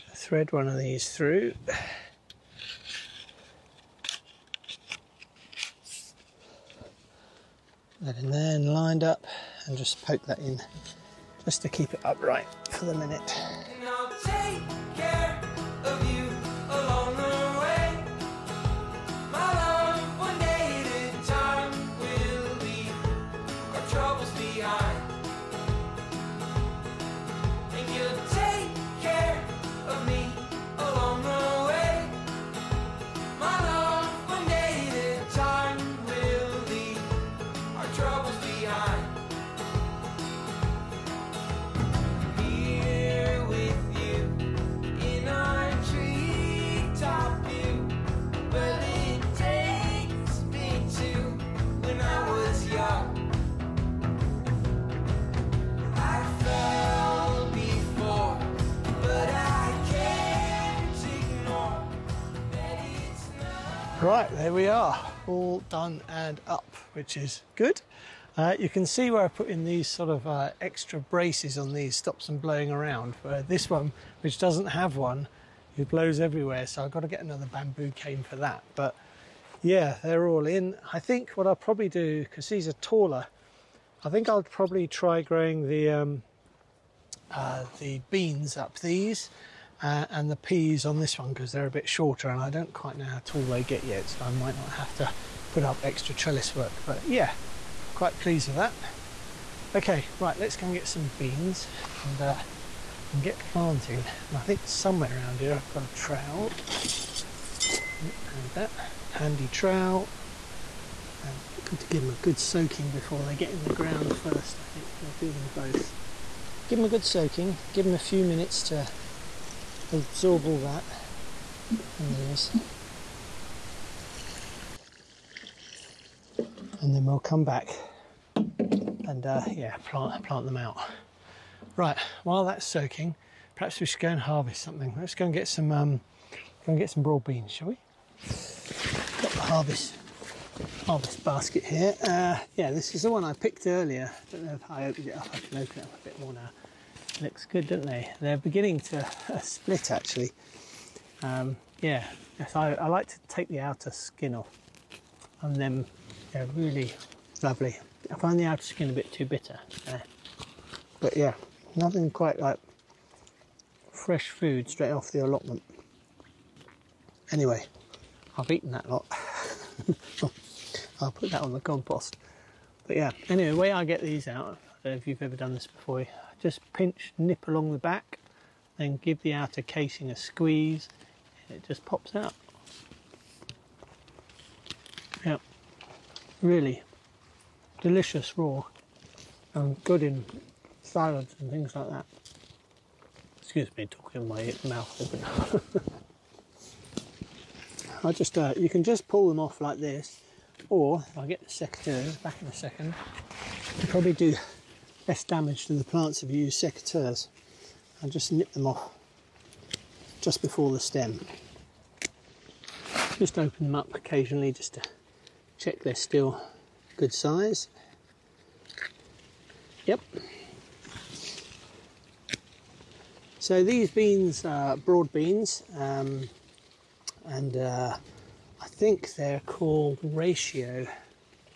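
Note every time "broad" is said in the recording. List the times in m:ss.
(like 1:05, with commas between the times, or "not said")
2:17, 3:44.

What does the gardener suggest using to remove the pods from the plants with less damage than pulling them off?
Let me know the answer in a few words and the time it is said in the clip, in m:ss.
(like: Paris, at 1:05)
secateurs, at 3:26.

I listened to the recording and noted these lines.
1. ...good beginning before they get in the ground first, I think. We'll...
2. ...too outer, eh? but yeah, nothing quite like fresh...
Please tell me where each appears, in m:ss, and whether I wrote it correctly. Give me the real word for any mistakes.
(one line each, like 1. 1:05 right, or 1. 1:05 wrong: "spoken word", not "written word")
1. 1:52 wrong: "soaking", not "beginning"
2. 2:39 wrong: "bitter", not "outer".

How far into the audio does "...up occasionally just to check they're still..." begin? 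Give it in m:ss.
3:33.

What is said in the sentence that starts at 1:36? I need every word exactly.
But yeah, quite pleased with that.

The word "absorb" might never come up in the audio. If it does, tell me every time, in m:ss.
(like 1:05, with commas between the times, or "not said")
2:00.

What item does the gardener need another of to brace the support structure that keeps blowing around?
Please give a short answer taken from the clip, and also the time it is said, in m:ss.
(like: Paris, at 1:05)
bamboo cane, at 1:17.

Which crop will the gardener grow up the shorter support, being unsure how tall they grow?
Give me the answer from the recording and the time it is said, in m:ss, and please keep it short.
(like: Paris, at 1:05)
peas, at 1:30.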